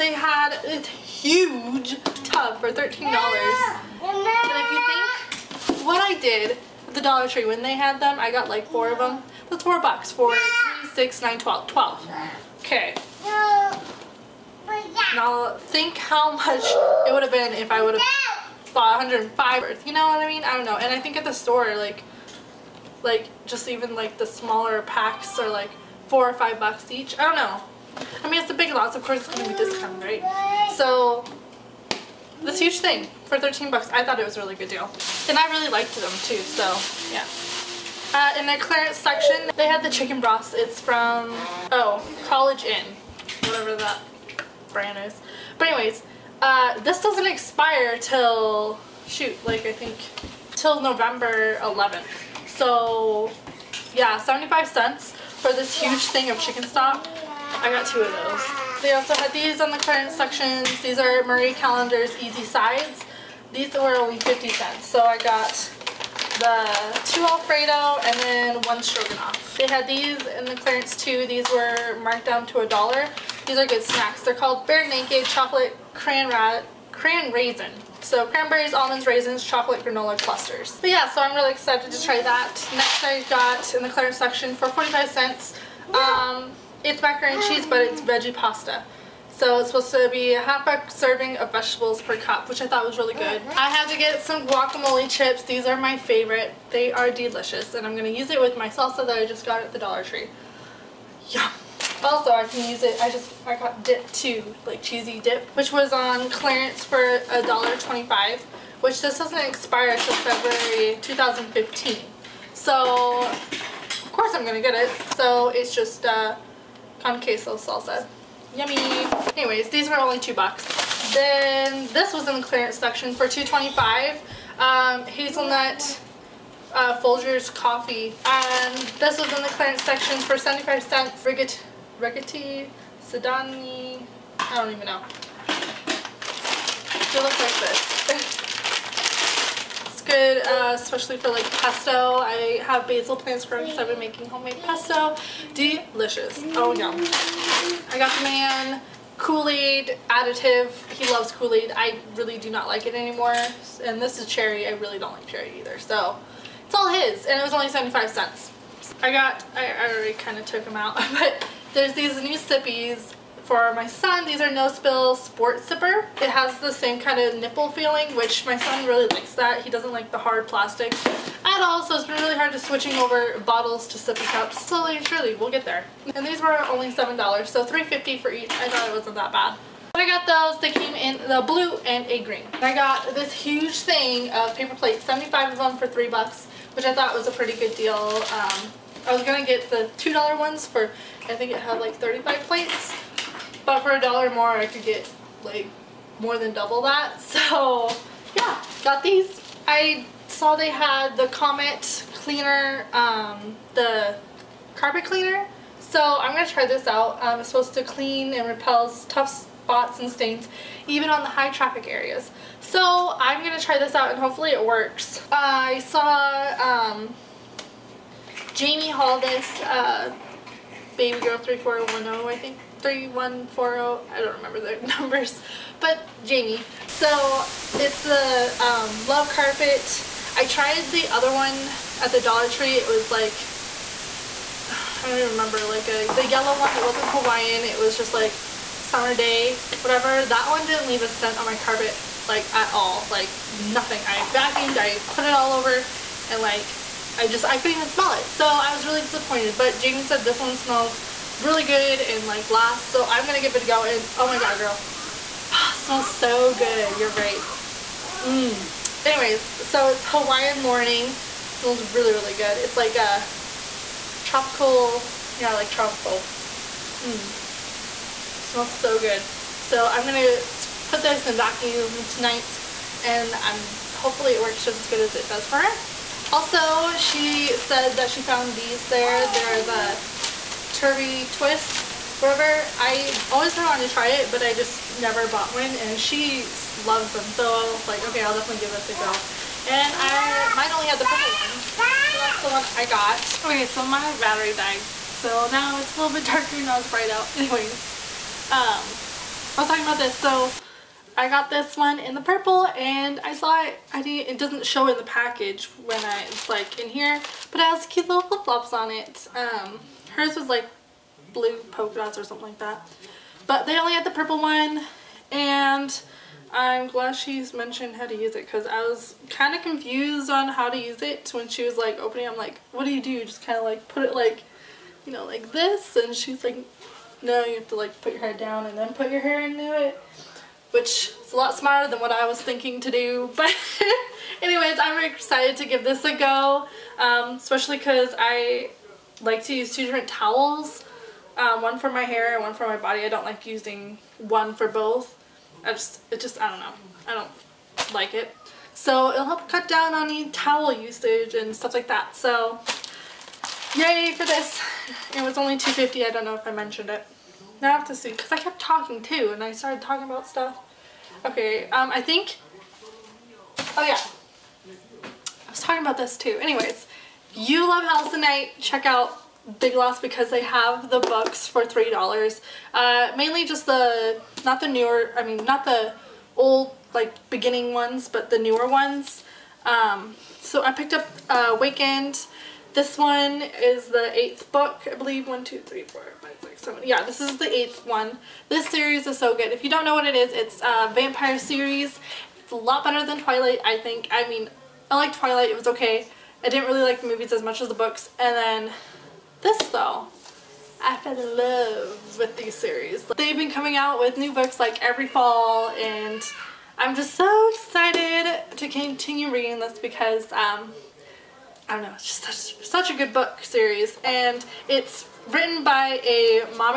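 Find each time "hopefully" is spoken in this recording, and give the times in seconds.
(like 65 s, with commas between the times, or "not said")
214 s, 273 s.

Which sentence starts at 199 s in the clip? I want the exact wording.
I saw they had the Comet cleaner, um, the carpet cleaner.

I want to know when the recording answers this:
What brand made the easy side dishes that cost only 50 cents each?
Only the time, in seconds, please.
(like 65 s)
61 s.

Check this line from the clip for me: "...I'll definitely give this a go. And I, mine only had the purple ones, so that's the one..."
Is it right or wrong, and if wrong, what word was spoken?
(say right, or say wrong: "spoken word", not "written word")
right.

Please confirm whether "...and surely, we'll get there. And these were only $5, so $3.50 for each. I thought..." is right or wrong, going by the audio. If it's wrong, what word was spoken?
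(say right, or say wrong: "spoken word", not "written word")
wrong: "7", not "5".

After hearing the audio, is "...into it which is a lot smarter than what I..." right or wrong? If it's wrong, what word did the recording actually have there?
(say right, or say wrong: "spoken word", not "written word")
right.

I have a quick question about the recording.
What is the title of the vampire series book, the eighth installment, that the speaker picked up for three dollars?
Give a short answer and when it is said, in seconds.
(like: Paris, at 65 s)
Wakened, at 381 s.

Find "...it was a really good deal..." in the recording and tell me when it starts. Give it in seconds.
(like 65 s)
34 s.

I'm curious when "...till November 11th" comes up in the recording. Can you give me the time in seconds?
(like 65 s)
50 s.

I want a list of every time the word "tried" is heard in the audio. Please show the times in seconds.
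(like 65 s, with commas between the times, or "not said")
230 s.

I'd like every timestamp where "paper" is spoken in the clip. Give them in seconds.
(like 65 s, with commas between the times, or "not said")
184 s.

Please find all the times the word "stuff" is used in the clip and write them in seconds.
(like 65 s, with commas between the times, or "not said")
351 s, 360 s.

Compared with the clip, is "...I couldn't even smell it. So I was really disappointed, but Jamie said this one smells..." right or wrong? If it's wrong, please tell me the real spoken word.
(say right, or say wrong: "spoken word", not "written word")
right.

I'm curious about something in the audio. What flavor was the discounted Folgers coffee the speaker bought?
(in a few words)
Hazelnut.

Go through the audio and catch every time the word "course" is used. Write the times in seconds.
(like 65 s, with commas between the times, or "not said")
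29 s, 114 s.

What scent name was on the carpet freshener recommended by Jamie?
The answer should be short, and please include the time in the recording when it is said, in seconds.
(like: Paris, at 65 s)
Hawaiian morning, at 260 s.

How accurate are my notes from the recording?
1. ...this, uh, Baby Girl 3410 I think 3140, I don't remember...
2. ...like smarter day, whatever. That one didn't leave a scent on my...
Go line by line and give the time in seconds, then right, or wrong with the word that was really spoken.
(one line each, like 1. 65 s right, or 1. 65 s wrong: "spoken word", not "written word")
1. 219 s right
2. 238 s wrong: "summer", not "smarter".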